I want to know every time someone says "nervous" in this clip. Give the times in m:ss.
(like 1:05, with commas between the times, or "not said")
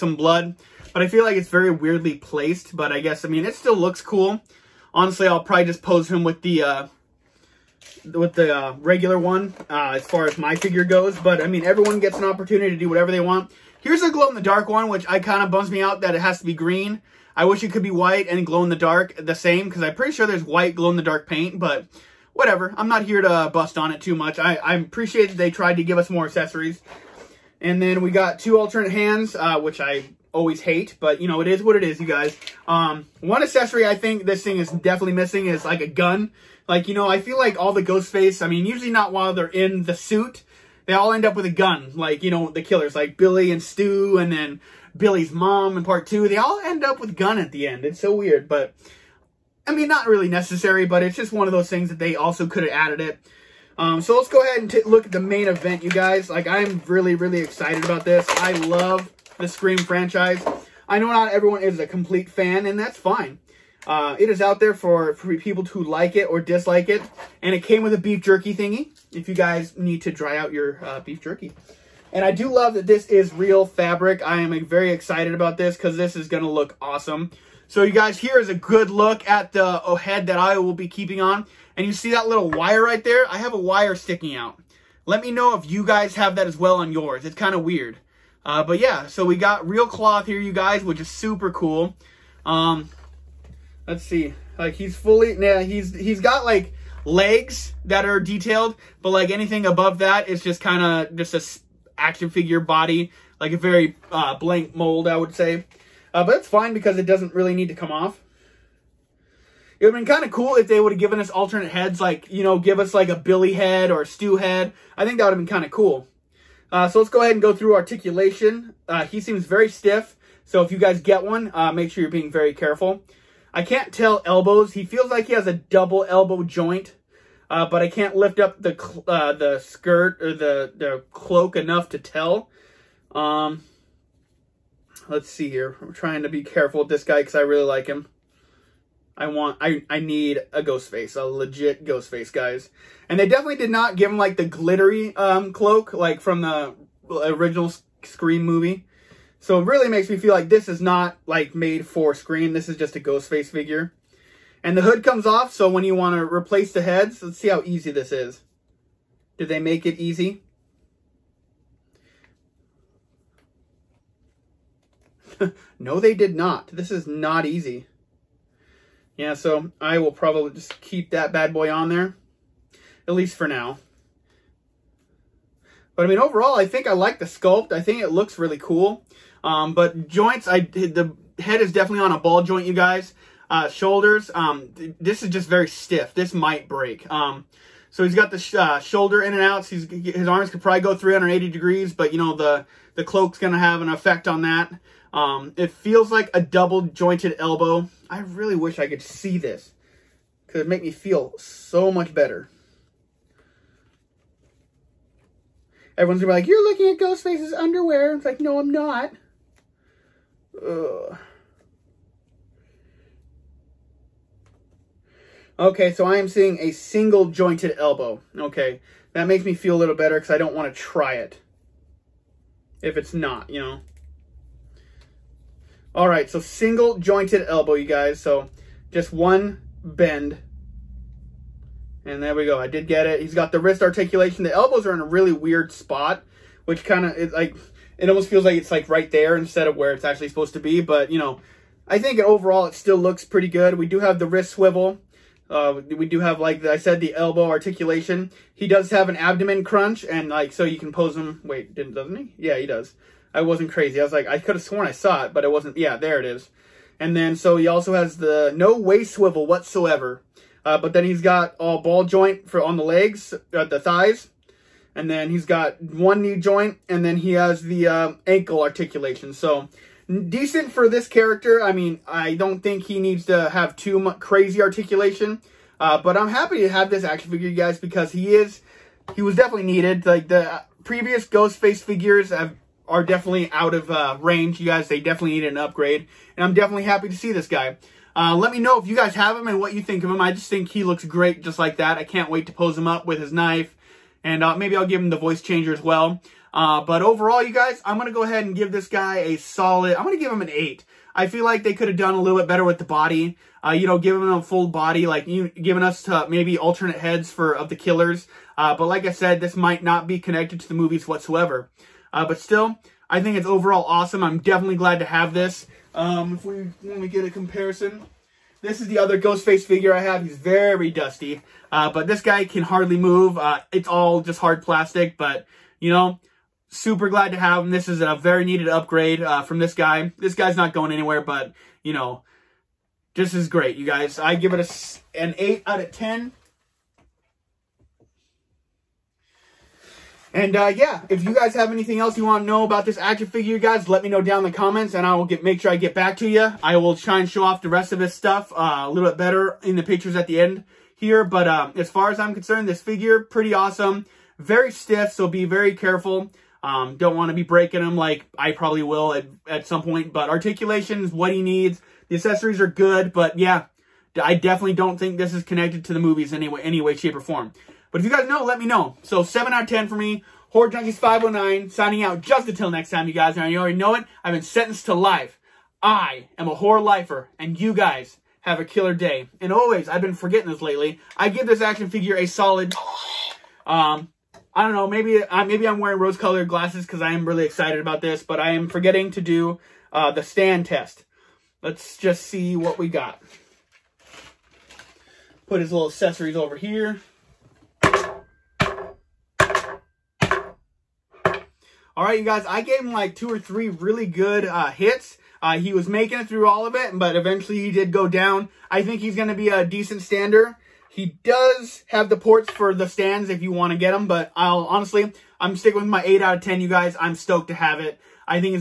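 not said.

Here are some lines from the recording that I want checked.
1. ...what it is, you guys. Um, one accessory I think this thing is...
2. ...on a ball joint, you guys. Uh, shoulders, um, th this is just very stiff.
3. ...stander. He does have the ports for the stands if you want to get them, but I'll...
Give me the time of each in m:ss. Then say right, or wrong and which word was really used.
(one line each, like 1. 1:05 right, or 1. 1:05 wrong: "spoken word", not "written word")
1. 0:31 right
2. 3:02 right
3. 6:50 right.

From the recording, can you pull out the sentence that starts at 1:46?
Uh, but it's fine because it doesn't really need to come off.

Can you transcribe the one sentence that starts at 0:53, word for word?
Um, so let's go ahead and look at the main event, you guys.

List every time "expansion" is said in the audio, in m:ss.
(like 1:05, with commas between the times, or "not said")
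not said.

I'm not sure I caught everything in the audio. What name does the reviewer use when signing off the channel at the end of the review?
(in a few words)
Horror Junkies 509.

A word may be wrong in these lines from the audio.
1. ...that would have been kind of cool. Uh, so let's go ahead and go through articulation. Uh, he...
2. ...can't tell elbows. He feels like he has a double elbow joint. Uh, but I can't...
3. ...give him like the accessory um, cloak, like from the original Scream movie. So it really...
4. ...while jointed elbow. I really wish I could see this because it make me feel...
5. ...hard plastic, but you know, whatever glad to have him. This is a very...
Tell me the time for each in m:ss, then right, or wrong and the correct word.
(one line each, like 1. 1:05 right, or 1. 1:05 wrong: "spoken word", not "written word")
1. 1:55 right
2. 2:03 right
3. 2:23 wrong: "glittery", not "accessory"
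4. 3:16 wrong: "double", not "while"
5. 5:24 wrong: "super", not "whatever".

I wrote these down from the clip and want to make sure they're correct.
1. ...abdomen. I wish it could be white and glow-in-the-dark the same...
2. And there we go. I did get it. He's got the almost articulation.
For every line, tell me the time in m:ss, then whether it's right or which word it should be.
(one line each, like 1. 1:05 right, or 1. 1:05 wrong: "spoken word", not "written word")
1. 0:16 wrong: "green", not "abdomen"
2. 3:52 wrong: "wrist", not "almost".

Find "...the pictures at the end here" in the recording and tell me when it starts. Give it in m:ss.
5:49.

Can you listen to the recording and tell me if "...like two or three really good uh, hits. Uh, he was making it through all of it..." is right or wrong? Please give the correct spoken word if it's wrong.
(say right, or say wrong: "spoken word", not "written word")
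right.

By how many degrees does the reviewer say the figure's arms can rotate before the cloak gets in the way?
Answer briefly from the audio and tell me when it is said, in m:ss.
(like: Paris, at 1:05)
380, at 3:10.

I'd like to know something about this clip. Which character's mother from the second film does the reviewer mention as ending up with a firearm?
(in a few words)
Billy's mom.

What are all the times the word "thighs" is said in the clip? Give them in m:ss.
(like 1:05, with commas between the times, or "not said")
4:23.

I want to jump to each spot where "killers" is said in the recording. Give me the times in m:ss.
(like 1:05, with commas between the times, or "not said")
0:42, 5:07, 6:18.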